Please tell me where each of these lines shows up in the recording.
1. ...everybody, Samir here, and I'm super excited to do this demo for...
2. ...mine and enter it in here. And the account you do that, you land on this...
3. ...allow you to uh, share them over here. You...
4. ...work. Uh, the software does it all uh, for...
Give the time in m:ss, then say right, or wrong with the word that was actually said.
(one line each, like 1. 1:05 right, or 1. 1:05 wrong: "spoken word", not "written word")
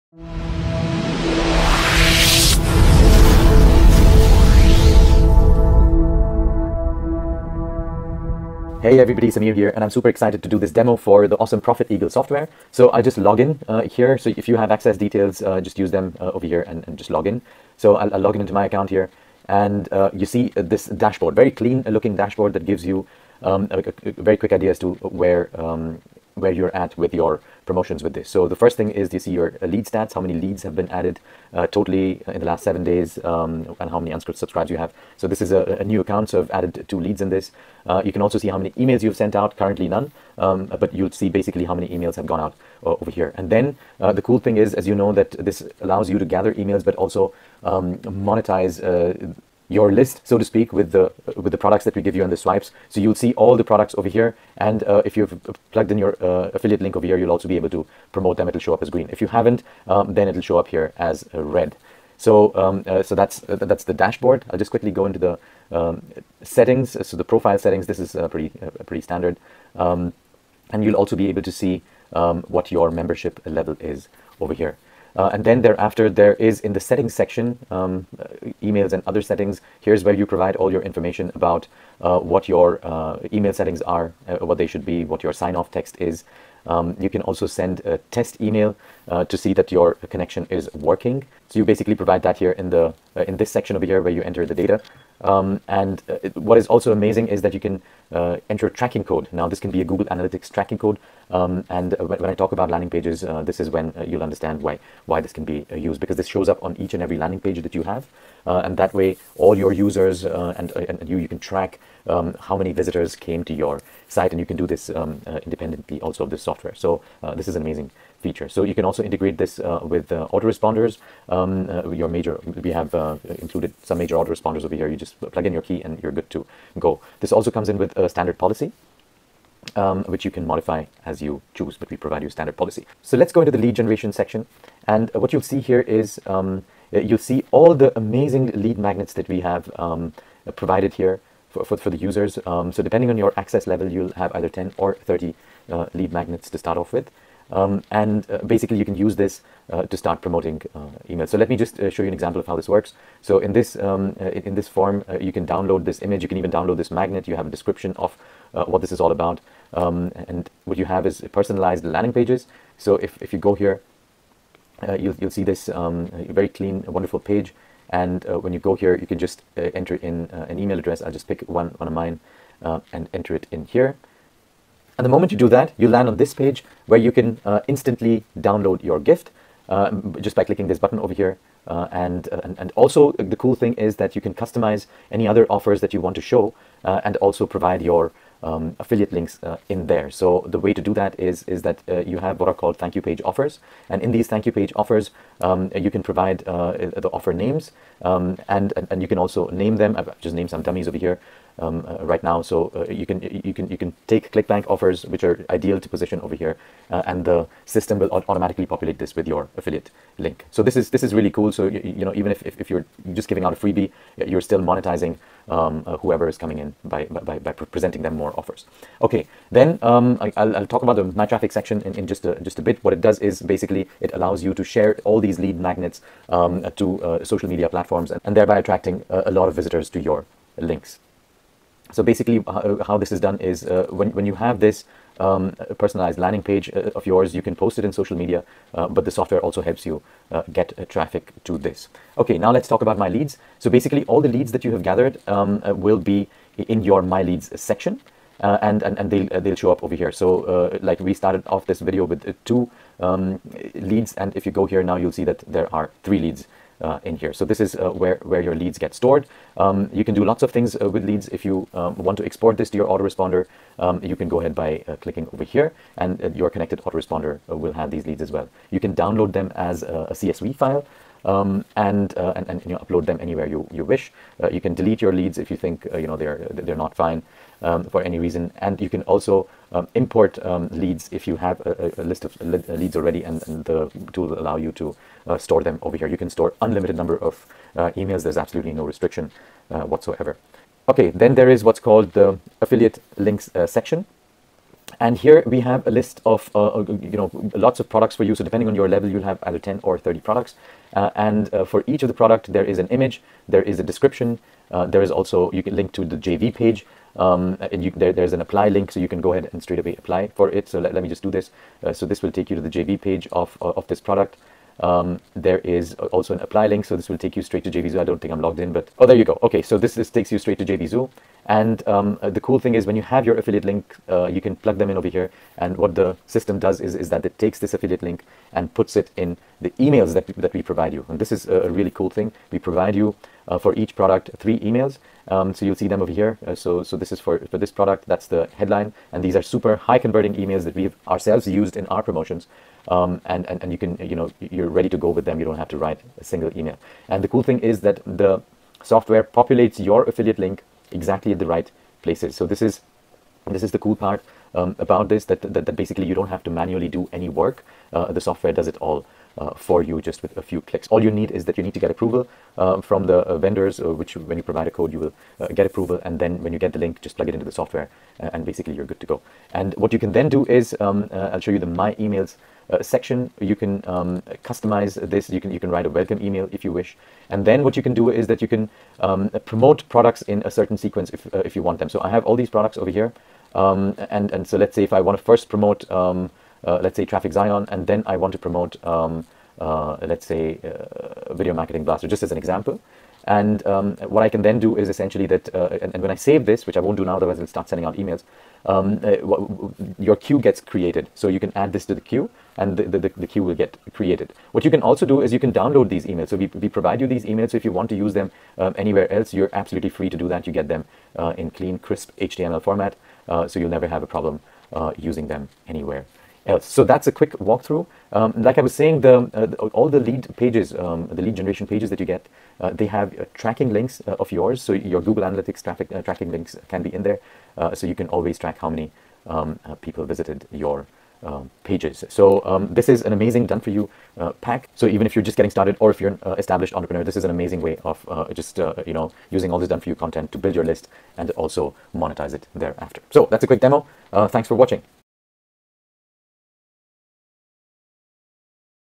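1. 0:08 right
2. 2:51 wrong: "moment", not "account"
3. 4:44 wrong: "store", not "share"
4. 5:57 right.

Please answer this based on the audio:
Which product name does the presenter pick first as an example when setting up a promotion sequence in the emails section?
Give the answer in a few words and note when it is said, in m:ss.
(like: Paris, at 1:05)
Traffic Zion, at 6:27.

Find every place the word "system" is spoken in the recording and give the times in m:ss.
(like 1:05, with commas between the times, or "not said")
3:27, 5:26.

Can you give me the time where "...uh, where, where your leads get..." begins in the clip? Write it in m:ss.
4:17.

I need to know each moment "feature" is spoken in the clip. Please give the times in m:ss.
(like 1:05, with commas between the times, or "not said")
1:58.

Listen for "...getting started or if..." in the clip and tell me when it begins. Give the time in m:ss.
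7:15.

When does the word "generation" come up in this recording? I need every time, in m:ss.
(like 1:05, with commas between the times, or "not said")
2:13, 7:01.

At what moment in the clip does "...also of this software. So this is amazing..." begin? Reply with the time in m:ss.
1:56.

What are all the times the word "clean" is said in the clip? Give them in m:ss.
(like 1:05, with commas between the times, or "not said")
0:21, 2:46, 6:51.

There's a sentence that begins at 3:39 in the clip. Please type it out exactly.
Okay, then um, I, will I'll talk about the my traffic section in, in just a, just a bit.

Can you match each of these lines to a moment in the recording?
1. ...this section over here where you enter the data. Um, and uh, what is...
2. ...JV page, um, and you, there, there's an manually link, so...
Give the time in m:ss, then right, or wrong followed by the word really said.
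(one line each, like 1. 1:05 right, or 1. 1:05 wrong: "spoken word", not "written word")
1. 1:33 right
2. 5:06 wrong: "apply", not "manually".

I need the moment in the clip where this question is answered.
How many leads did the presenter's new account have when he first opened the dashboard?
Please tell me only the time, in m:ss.
0:36.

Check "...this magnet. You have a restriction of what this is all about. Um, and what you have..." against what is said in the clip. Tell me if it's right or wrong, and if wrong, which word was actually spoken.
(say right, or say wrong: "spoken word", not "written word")
wrong: "description", not "restriction".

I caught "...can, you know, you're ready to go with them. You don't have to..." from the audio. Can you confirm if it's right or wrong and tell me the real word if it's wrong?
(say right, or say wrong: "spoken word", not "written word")
right.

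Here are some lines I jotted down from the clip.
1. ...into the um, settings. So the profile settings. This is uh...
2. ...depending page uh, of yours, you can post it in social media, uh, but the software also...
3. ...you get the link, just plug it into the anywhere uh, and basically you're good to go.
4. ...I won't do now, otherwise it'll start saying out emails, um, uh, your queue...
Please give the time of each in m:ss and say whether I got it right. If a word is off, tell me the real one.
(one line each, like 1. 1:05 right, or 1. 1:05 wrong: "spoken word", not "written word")
1. 1:05 right
2. 3:56 wrong: "landing", not "depending"
3. 6:06 wrong: "software", not "anywhere"
4. 6:36 wrong: "sending", not "saying".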